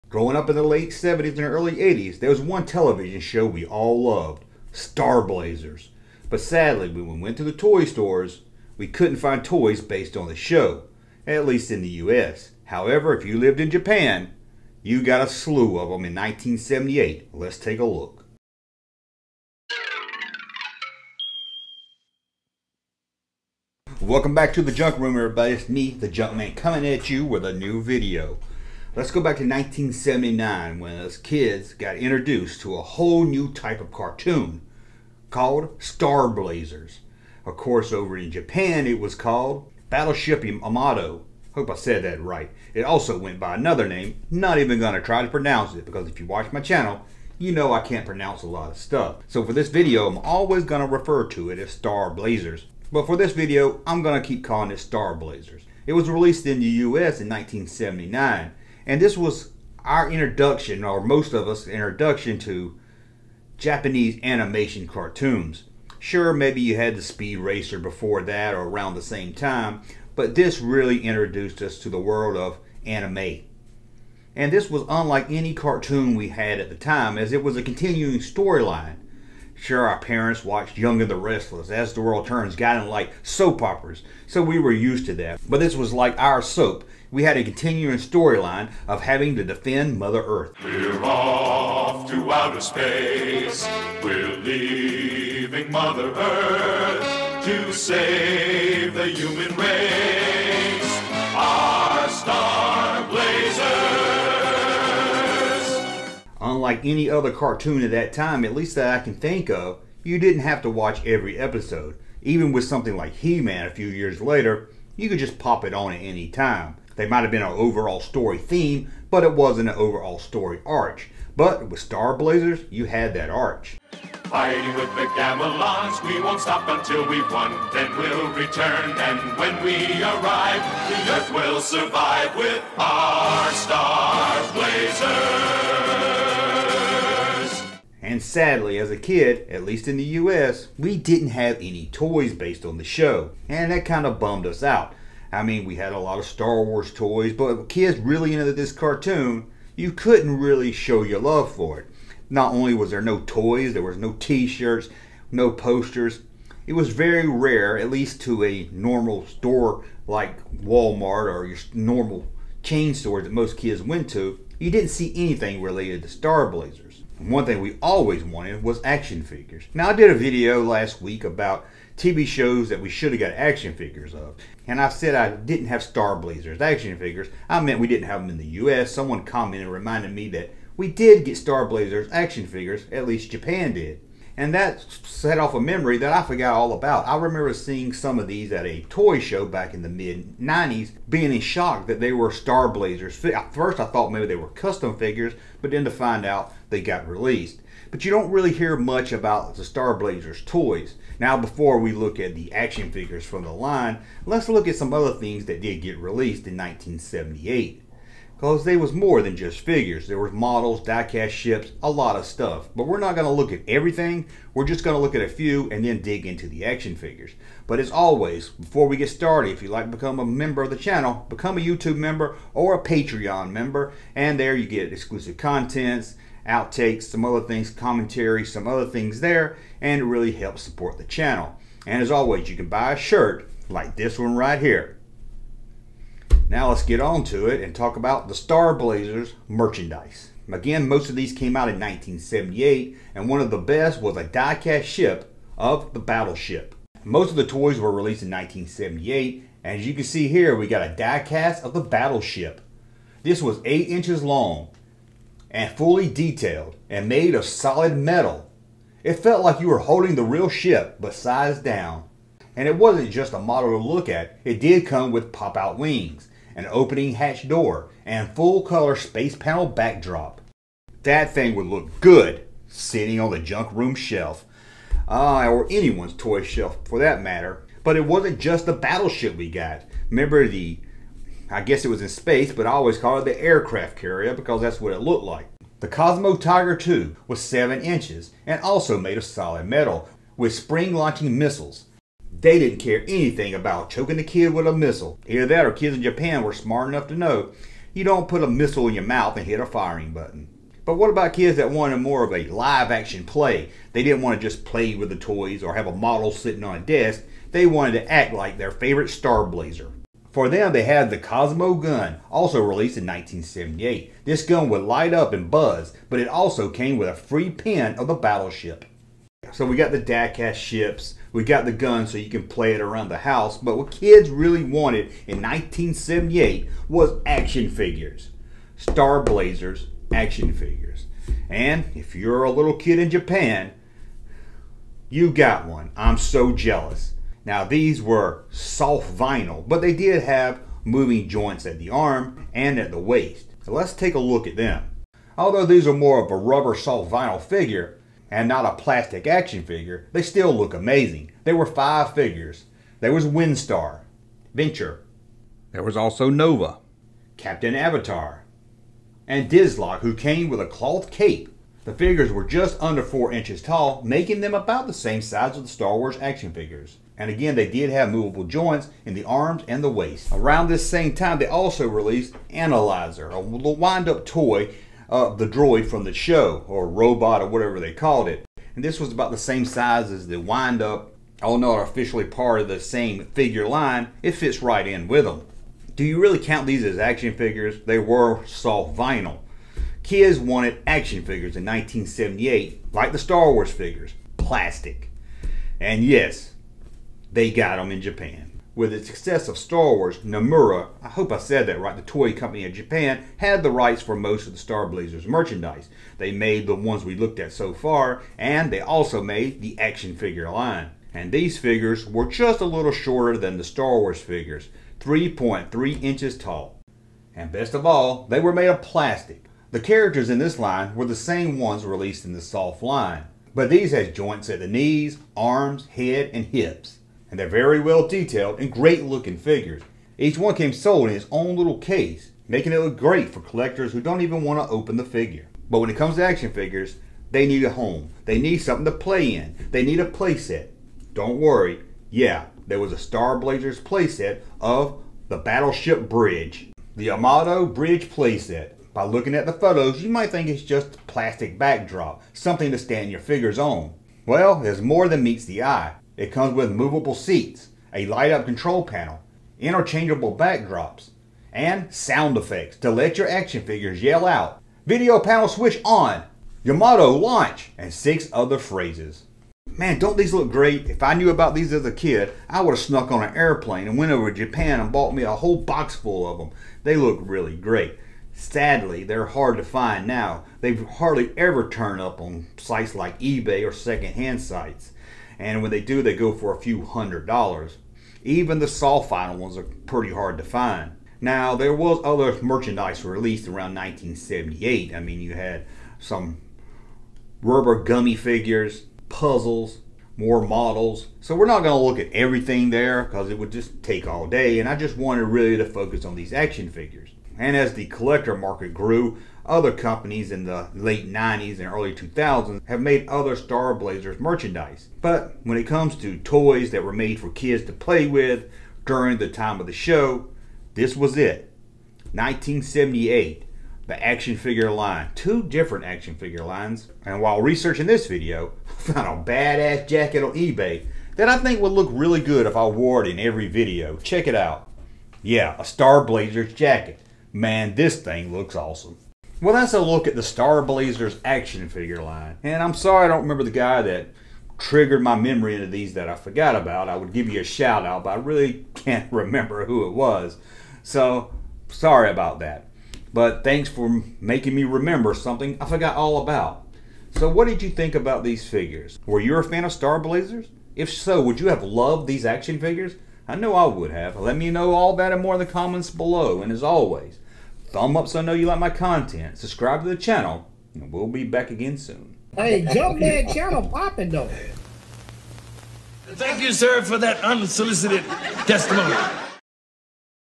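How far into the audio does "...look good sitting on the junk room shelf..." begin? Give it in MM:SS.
04:31.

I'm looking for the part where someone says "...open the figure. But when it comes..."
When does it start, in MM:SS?
07:14.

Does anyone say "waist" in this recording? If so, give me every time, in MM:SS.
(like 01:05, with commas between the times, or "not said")
05:42, 06:09.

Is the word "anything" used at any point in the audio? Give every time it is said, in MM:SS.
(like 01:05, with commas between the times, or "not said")
02:45, 04:53.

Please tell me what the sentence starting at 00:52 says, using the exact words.
But for this video, I'm going to keep calling it Star Blazers.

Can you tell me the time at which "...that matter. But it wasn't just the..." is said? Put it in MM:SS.
04:36.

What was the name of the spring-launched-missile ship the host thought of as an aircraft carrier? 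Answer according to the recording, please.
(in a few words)
Cosmo Tiger II.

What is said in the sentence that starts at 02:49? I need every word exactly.
Now, I did a video last week about TV shows that we should have got action figures of.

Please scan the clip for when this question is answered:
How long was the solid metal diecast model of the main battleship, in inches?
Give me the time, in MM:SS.
04:13.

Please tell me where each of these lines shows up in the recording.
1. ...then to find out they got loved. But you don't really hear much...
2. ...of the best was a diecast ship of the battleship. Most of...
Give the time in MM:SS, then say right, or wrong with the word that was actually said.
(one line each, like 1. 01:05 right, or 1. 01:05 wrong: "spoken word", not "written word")
1. 03:15 wrong: "released", not "loved"
2. 04:03 right.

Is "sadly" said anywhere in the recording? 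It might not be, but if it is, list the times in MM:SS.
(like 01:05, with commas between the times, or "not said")
00:06, 02:18, 07:58.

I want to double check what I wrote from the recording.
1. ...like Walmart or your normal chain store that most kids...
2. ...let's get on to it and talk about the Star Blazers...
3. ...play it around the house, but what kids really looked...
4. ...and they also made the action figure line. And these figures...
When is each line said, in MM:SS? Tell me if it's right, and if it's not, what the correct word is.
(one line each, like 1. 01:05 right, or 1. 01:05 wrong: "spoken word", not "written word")
1. 02:40 right
2. 03:56 right
3. 05:22 wrong: "wanted", not "looked"
4. 06:48 right.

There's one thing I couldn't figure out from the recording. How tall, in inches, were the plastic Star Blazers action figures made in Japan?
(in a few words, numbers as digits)
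3.3 inches.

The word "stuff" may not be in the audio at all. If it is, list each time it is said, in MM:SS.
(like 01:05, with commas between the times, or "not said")
00:48, 03:32.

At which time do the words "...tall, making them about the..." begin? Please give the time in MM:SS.
06:03.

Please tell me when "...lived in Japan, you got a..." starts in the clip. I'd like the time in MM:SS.
00:13.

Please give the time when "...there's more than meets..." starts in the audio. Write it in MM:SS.
07:34.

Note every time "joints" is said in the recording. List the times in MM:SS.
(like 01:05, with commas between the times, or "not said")
05:41, 06:08, 07:04.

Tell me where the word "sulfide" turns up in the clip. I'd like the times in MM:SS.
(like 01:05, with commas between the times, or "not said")
08:08.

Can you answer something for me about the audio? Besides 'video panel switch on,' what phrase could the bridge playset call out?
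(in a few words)
Yamato launch.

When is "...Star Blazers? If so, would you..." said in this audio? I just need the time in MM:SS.
09:19.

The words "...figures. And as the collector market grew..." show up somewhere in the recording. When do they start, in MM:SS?
08:26.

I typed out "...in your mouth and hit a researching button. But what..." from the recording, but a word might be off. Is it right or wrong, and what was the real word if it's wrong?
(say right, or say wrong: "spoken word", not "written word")
wrong: "firing", not "researching".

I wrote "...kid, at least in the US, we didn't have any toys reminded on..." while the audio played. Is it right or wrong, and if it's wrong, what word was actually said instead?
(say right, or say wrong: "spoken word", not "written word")
wrong: "based", not "reminded".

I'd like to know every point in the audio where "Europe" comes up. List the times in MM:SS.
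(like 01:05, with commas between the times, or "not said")
not said.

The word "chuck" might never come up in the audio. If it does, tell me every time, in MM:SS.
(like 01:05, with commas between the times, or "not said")
not said.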